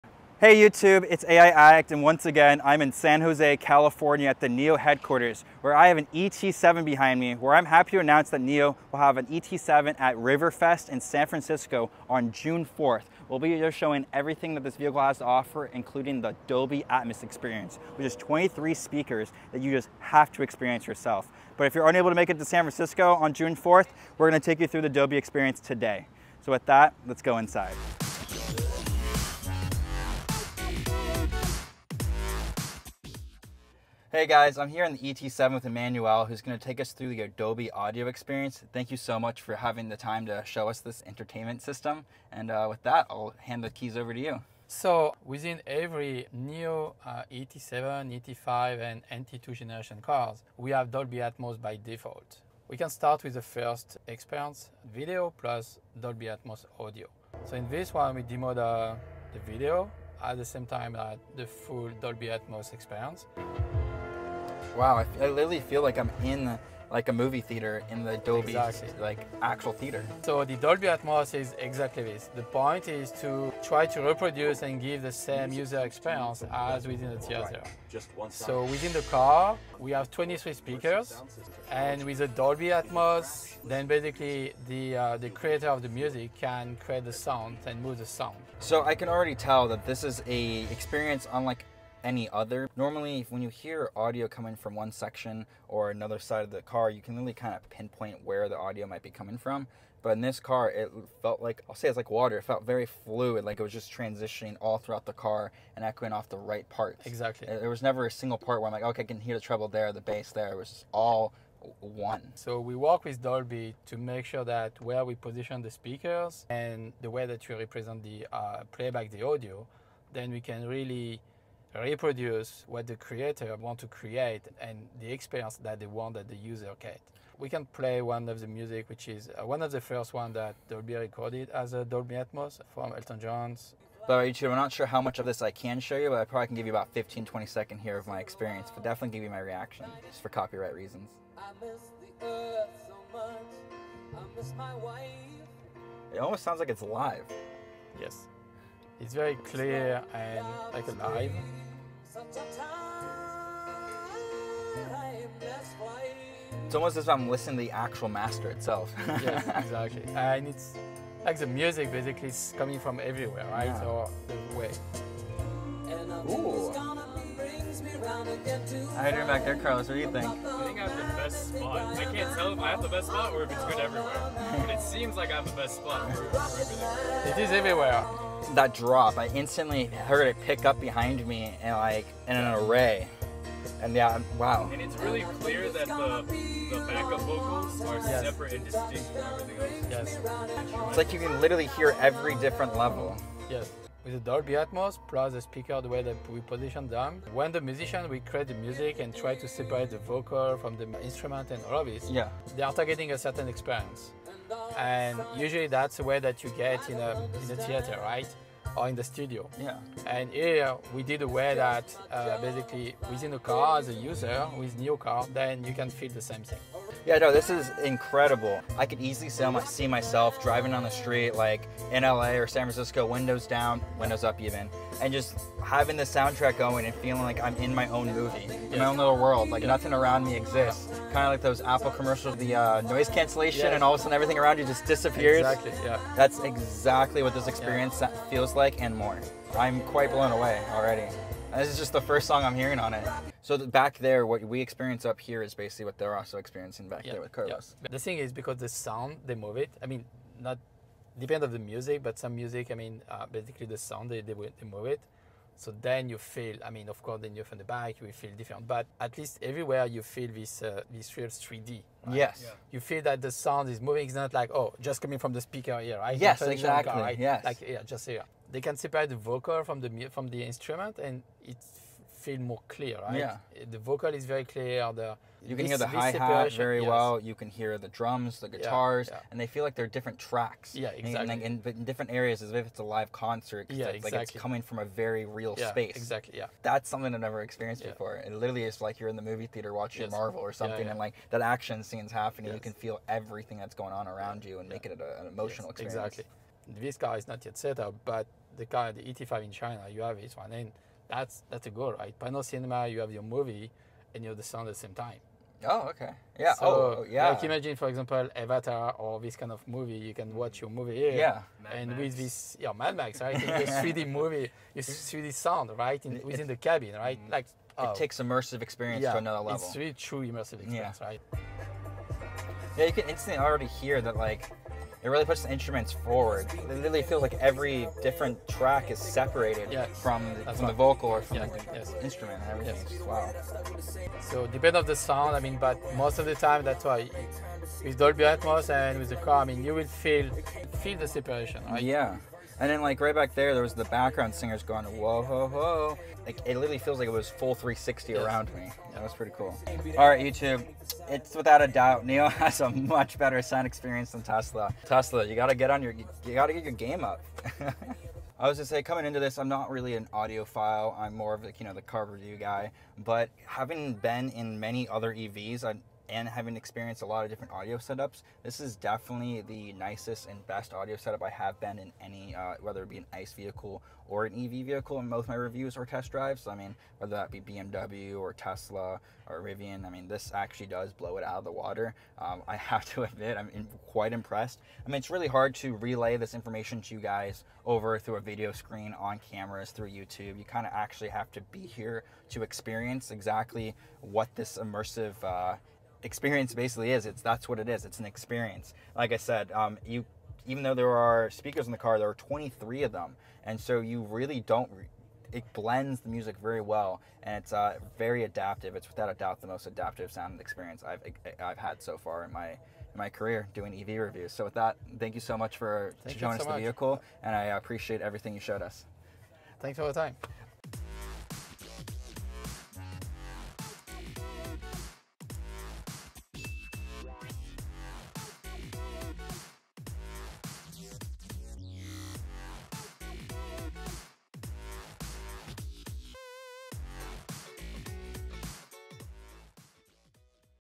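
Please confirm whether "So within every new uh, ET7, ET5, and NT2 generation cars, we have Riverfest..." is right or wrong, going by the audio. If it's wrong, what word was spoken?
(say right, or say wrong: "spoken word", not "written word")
wrong: "Dolby", not "Riverfest".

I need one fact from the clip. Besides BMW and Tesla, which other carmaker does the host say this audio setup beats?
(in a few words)
Rivian.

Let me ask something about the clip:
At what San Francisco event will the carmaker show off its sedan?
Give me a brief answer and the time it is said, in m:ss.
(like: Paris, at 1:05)
Riverfest, at 0:10.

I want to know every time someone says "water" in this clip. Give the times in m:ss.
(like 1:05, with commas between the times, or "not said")
1:42, 6:21.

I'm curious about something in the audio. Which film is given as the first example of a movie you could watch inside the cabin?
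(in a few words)
Avatar.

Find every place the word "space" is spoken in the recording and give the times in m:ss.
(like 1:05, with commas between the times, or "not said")
4:45.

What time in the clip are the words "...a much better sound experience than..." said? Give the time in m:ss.
5:52.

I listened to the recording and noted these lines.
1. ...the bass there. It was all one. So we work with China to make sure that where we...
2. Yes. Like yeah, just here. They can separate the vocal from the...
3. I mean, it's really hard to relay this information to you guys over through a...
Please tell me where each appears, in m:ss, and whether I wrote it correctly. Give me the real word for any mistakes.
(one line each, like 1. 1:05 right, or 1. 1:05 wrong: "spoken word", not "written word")
1. 1:49 wrong: "Dolby", not "China"
2. 4:27 right
3. 6:24 right.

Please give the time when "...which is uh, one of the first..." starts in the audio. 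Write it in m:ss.
2:08.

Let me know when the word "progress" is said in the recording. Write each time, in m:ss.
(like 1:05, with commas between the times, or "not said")
not said.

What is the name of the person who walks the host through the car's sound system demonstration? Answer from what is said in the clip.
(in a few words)
Emmanuel.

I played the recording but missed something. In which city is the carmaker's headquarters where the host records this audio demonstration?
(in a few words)
San Jose.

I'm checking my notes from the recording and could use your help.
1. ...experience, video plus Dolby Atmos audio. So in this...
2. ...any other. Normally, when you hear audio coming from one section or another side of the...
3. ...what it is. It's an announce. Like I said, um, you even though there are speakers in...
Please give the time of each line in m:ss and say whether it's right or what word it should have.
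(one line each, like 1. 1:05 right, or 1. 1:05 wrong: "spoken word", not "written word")
1. 0:54 right
2. 1:32 right
3. 6:37 wrong: "experience", not "announce".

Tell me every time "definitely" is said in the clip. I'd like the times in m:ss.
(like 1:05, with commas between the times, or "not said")
2:18, 6:08.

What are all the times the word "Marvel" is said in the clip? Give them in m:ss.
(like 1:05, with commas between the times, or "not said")
4:50.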